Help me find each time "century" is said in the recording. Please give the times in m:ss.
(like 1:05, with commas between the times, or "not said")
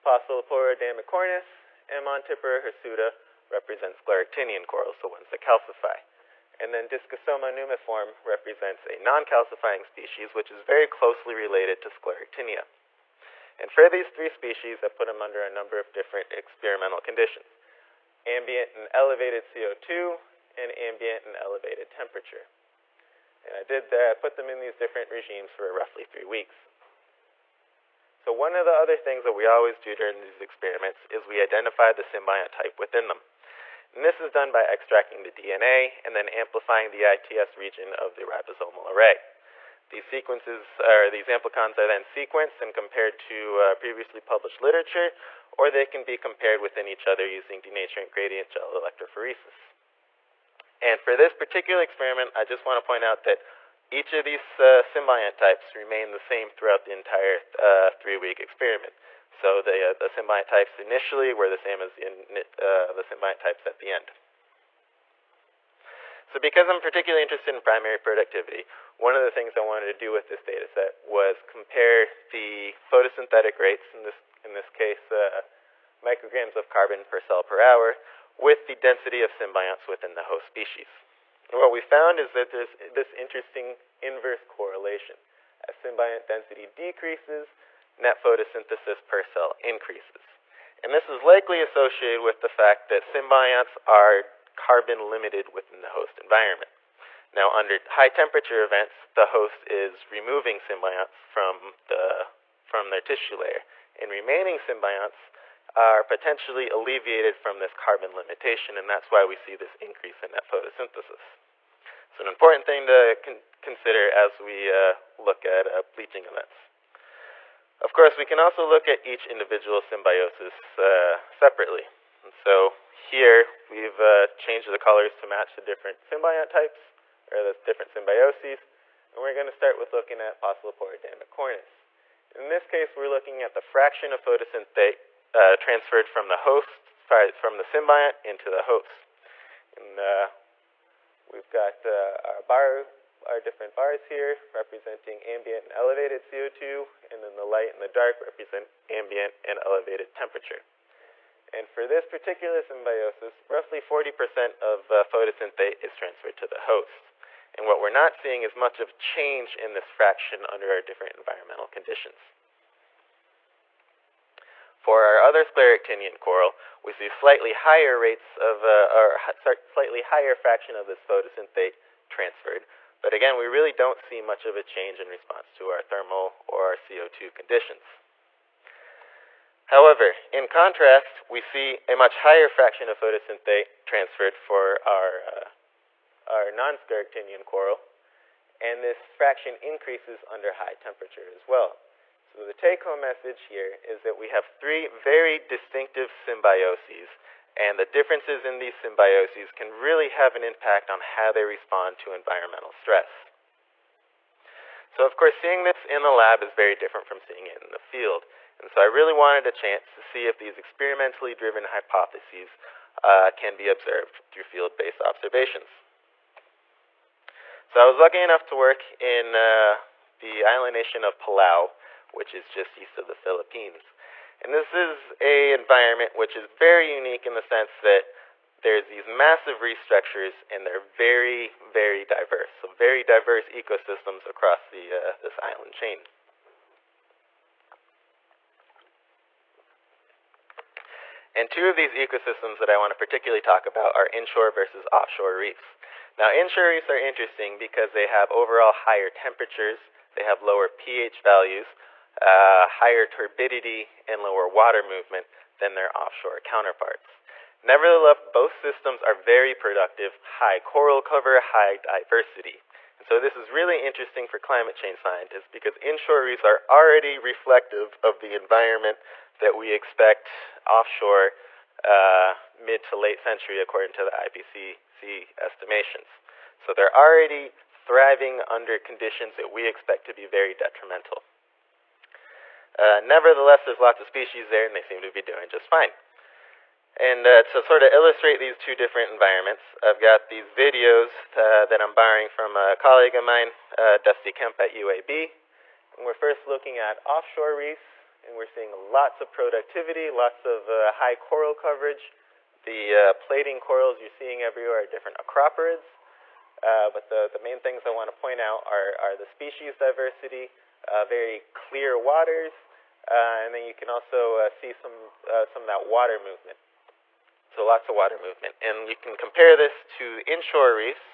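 4:33.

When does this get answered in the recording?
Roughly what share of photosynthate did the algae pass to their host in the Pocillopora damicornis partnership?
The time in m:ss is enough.
2:33.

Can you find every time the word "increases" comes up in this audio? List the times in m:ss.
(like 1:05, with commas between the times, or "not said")
1:29, 1:49, 3:09.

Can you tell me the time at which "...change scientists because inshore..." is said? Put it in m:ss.
4:24.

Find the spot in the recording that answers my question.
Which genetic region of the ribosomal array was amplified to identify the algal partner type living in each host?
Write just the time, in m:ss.
0:37.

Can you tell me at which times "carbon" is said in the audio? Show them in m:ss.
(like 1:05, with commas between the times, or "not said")
1:16, 1:34, 1:47.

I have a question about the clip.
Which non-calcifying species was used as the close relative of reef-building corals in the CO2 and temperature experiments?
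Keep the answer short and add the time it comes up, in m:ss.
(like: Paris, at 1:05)
Discosoma nummiforme, at 0:06.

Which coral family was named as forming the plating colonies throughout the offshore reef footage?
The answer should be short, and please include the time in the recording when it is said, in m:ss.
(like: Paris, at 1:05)
acroporids, at 5:05.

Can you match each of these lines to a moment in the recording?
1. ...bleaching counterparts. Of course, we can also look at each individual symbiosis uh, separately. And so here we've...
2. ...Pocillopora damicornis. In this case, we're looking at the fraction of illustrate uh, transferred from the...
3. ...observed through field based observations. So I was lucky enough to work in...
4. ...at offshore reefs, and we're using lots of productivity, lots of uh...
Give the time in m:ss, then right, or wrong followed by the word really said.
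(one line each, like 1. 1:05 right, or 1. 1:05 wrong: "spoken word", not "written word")
1. 1:55 wrong: "events", not "counterparts"
2. 2:10 wrong: "photosynthate", not "illustrate"
3. 3:33 right
4. 4:56 wrong: "seeing", not "using".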